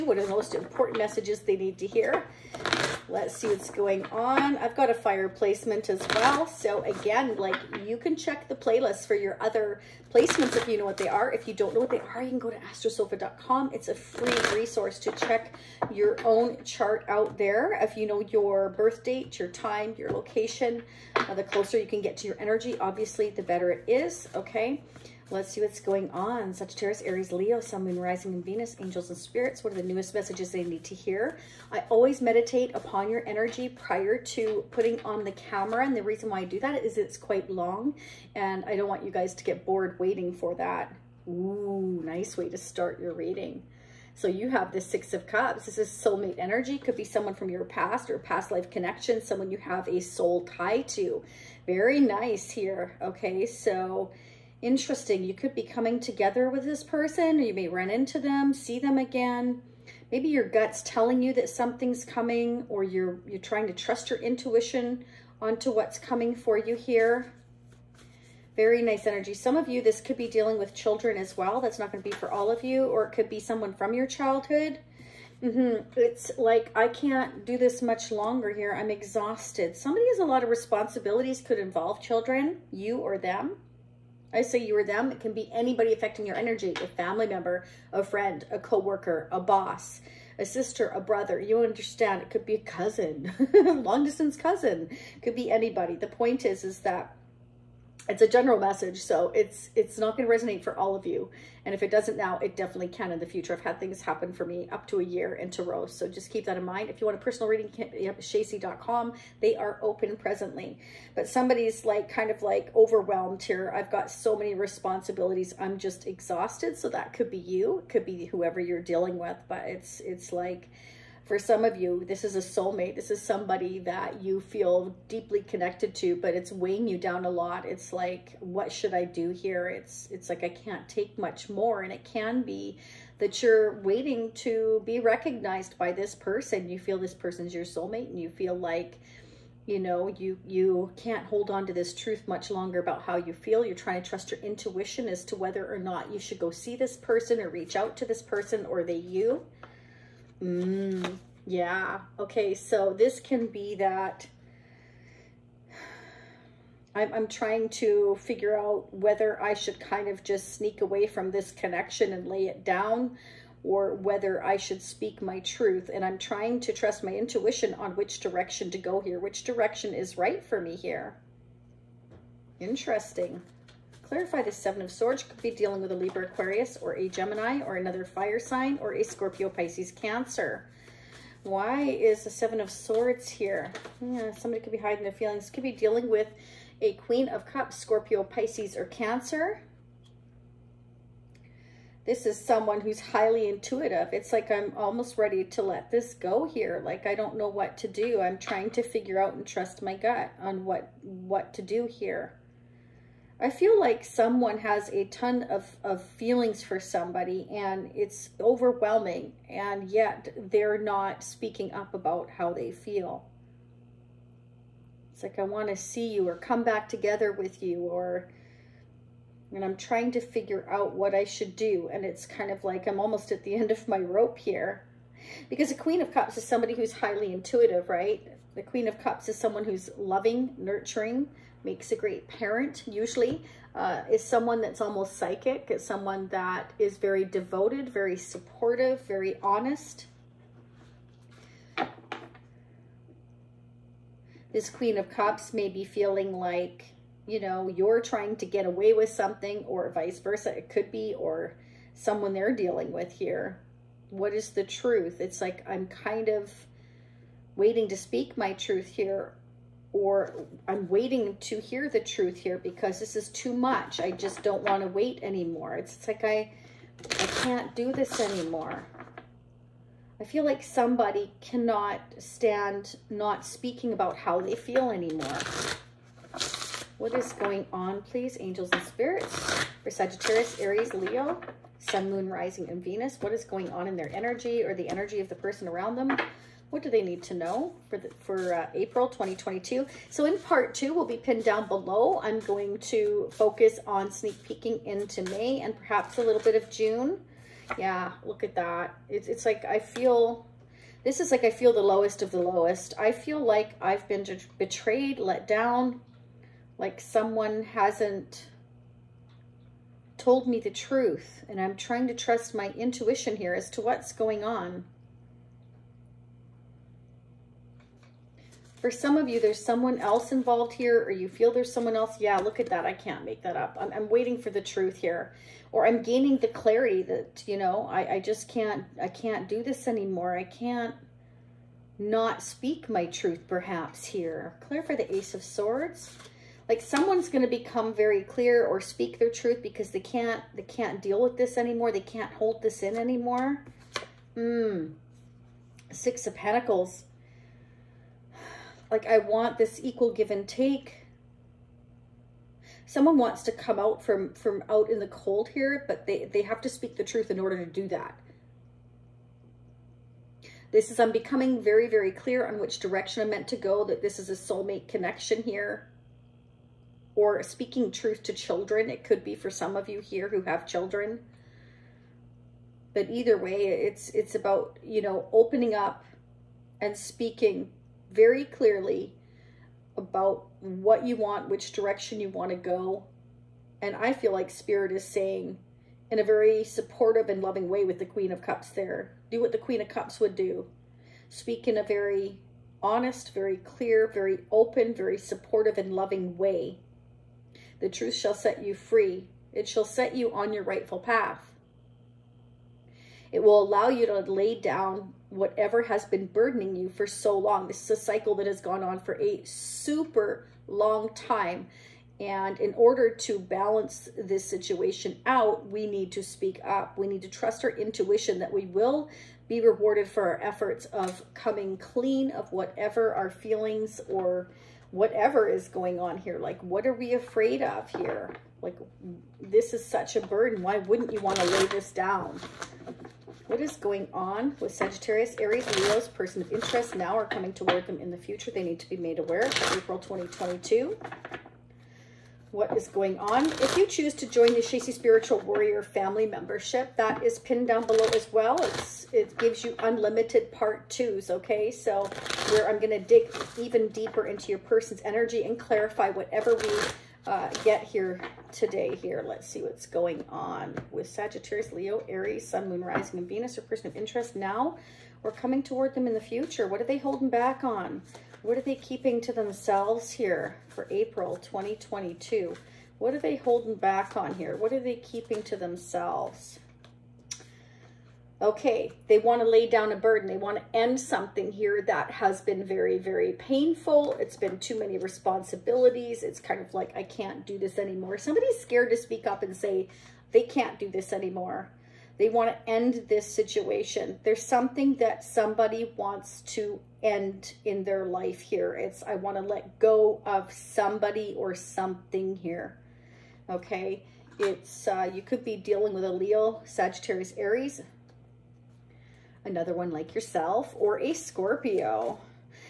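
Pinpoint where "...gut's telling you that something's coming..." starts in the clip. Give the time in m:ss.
1:00.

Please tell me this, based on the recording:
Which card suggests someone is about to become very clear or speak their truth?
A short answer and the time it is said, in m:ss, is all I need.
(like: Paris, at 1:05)
Ace of Swords, at 5:35.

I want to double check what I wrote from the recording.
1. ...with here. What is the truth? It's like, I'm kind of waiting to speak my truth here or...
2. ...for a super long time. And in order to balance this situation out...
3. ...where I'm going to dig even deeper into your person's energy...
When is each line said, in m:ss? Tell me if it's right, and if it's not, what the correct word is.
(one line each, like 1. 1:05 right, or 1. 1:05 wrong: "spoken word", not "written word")
1. 4:12 right
2. 6:48 right
3. 7:32 right.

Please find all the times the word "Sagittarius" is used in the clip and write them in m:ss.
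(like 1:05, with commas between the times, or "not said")
0:26, 4:39, 7:14, 7:41, 8:26.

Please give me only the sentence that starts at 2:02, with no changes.
This is somebody that you feel deeply connected to, but it's weighing you down a lot.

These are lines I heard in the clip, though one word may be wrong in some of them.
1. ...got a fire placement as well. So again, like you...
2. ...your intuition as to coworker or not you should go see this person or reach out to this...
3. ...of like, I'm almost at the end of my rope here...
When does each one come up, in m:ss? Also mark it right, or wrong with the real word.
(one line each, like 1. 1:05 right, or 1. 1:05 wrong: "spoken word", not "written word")
1. 0:04 right
2. 2:24 wrong: "whether", not "coworker"
3. 3:42 right.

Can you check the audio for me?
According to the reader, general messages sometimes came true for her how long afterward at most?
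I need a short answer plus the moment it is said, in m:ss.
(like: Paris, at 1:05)
a year, at 1:44.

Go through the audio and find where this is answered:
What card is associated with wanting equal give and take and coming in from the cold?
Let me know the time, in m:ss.
5:45.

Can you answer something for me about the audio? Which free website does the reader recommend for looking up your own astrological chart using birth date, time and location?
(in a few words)
astrosofa.com.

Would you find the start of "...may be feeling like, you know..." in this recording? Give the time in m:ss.
4:05.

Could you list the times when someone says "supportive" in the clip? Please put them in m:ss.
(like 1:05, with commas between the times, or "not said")
3:58, 6:26, 6:35.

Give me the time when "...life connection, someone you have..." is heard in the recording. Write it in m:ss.
0:48.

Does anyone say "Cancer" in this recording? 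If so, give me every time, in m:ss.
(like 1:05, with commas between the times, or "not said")
2:59, 3:08.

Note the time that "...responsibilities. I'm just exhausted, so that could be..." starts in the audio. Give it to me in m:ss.
1:54.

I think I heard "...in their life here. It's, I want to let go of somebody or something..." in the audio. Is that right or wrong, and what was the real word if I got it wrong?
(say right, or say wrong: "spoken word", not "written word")
right.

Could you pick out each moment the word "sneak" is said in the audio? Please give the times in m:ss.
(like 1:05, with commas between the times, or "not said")
2:40, 4:54.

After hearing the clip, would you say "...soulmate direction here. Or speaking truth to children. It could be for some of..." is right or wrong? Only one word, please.
wrong.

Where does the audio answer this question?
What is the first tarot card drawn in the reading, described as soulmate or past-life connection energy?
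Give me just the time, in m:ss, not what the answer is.
0:44.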